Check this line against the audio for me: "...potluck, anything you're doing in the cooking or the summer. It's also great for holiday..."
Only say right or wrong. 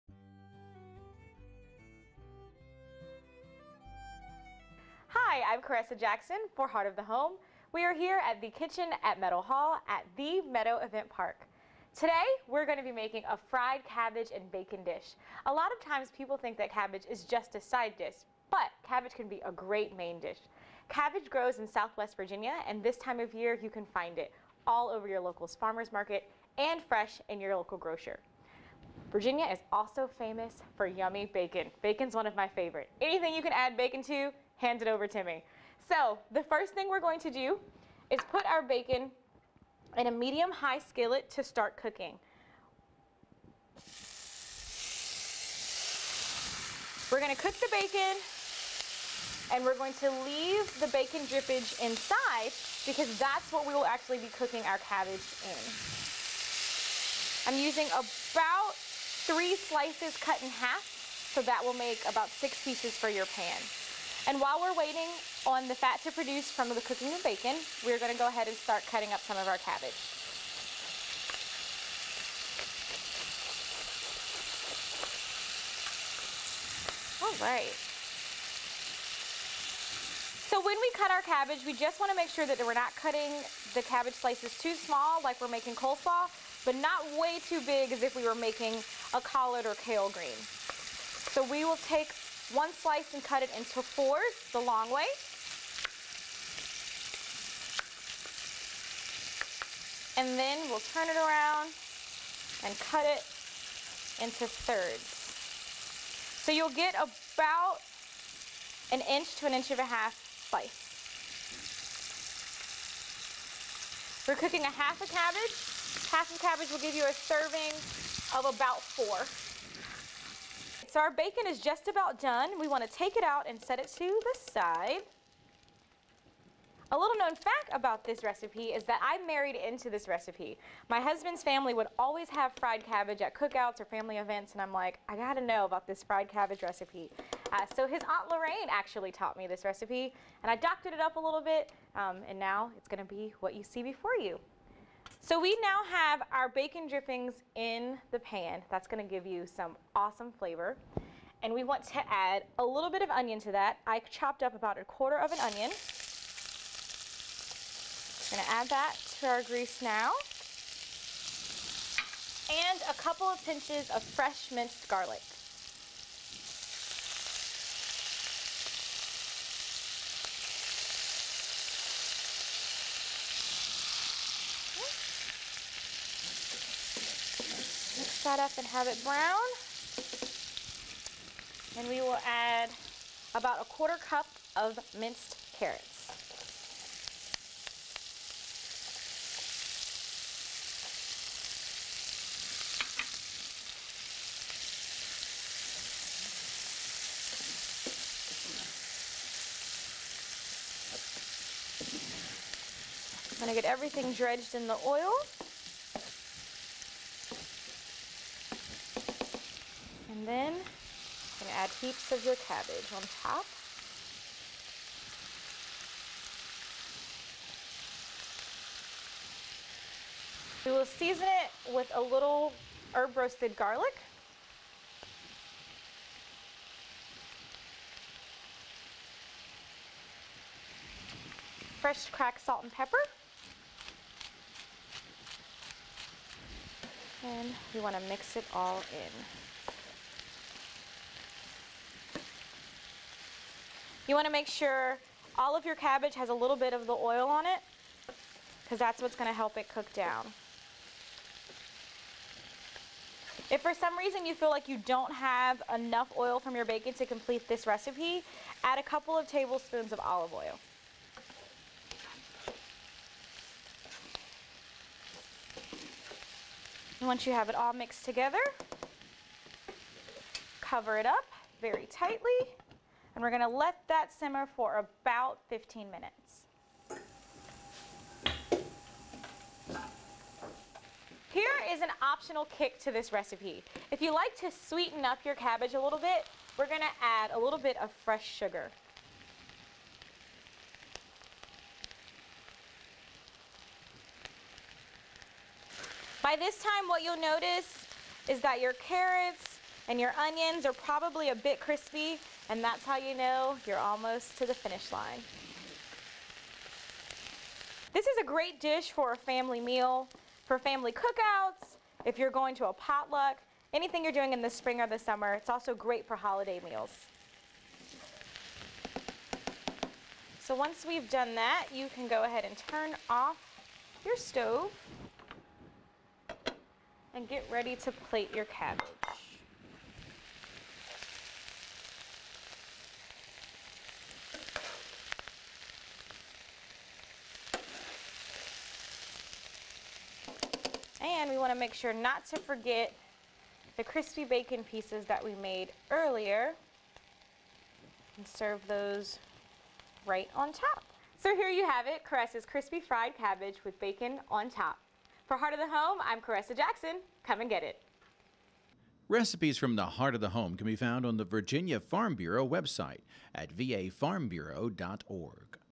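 wrong.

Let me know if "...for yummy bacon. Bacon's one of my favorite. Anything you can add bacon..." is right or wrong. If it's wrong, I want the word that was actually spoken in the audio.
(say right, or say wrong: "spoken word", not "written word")
right.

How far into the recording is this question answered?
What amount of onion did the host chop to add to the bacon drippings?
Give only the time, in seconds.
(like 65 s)
154 s.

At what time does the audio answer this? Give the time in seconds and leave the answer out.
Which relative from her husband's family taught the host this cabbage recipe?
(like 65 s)
138 s.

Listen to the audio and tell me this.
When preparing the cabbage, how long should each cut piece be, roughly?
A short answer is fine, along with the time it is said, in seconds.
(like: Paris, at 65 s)
1 to 1.5 inches, at 108 s.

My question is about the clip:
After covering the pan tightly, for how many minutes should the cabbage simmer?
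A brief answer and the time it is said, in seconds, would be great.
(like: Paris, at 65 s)
15 minutes, at 275 s.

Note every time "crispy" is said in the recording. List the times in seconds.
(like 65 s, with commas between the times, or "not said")
301 s, 343 s, 352 s.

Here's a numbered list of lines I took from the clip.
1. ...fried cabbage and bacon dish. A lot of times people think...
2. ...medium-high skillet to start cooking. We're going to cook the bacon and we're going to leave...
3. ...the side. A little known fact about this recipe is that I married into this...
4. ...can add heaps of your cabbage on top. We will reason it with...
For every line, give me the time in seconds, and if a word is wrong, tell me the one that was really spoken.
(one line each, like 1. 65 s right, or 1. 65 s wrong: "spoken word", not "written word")
1. 13 s right
2. 40 s right
3. 124 s right
4. 211 s wrong: "season", not "reason".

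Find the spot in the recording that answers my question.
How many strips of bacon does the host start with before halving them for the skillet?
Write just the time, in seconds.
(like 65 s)
59 s.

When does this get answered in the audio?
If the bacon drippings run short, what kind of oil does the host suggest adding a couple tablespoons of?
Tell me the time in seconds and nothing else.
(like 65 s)
260 s.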